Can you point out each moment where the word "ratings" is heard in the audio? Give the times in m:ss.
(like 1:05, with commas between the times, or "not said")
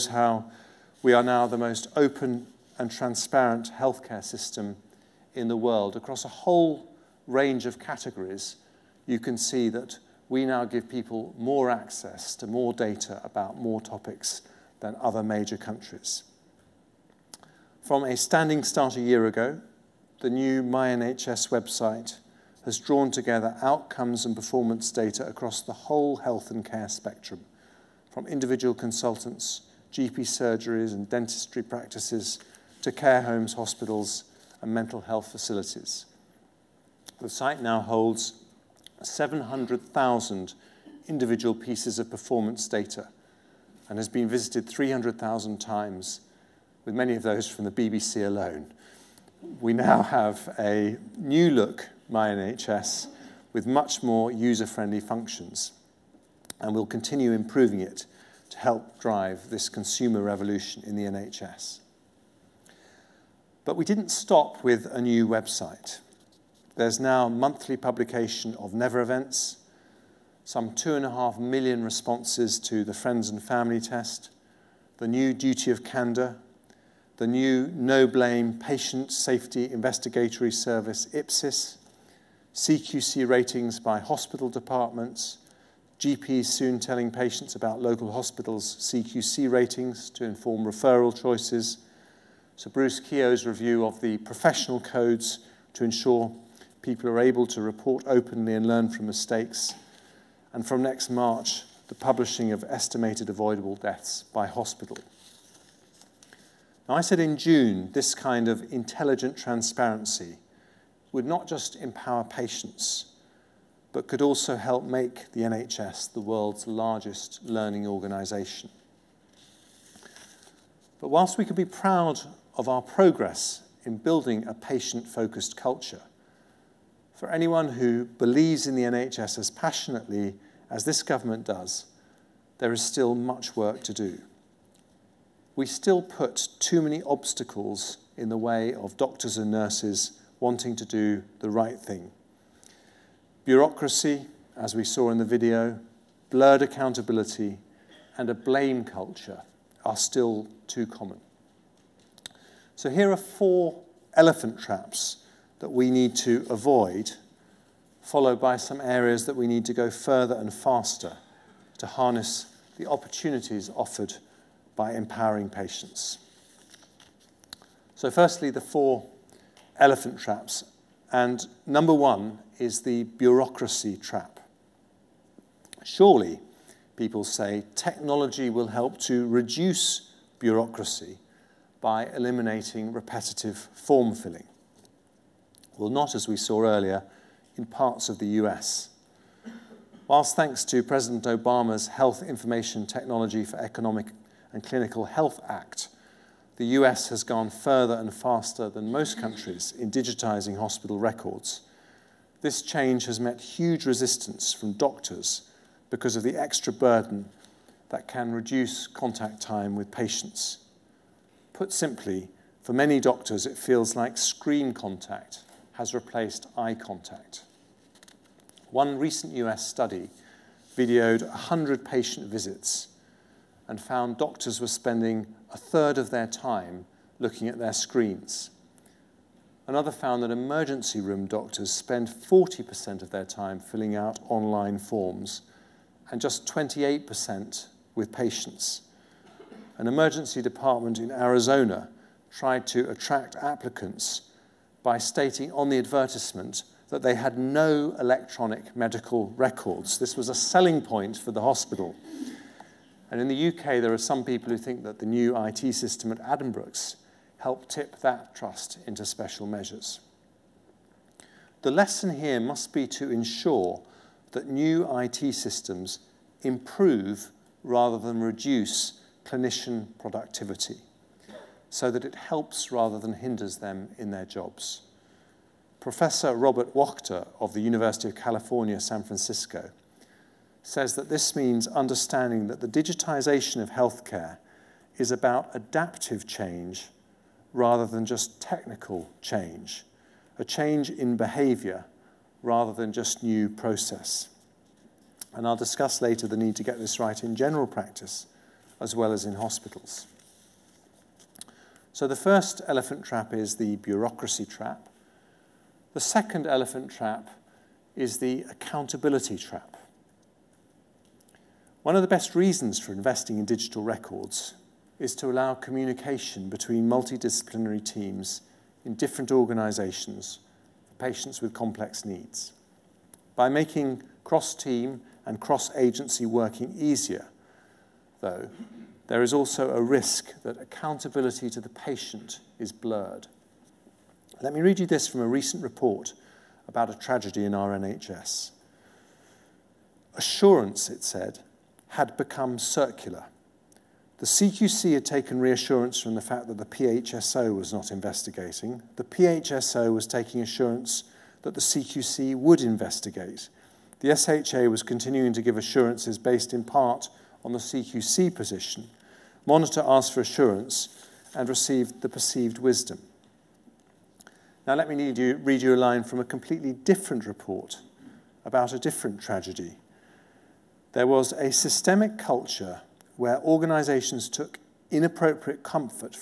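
1:23, 1:29.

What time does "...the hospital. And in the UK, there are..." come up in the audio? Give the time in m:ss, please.
4:11.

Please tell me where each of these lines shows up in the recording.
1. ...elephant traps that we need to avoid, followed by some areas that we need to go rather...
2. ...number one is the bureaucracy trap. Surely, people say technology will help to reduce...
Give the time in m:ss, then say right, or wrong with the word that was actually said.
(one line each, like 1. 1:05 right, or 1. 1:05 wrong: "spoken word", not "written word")
1. 2:34 wrong: "further", not "rather"
2. 2:51 right.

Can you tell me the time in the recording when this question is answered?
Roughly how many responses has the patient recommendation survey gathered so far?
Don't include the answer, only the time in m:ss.
1:10.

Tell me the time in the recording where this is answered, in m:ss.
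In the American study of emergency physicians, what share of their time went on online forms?
3:52.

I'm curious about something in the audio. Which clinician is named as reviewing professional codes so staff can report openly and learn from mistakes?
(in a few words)
Bruce Keogh.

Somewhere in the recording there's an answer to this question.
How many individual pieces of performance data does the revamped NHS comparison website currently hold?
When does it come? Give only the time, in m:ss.
0:39.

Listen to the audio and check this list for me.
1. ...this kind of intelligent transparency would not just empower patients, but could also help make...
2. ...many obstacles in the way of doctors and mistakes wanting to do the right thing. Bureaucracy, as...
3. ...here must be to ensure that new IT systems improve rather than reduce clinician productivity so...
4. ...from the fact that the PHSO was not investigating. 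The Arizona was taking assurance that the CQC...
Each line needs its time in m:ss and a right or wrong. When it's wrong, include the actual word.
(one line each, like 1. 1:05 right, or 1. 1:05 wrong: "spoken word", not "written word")
1. 1:47 right
2. 2:16 wrong: "nurses", not "mistakes"
3. 4:22 right
4. 5:46 wrong: "PHSO", not "Arizona".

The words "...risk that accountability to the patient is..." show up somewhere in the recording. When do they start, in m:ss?
5:29.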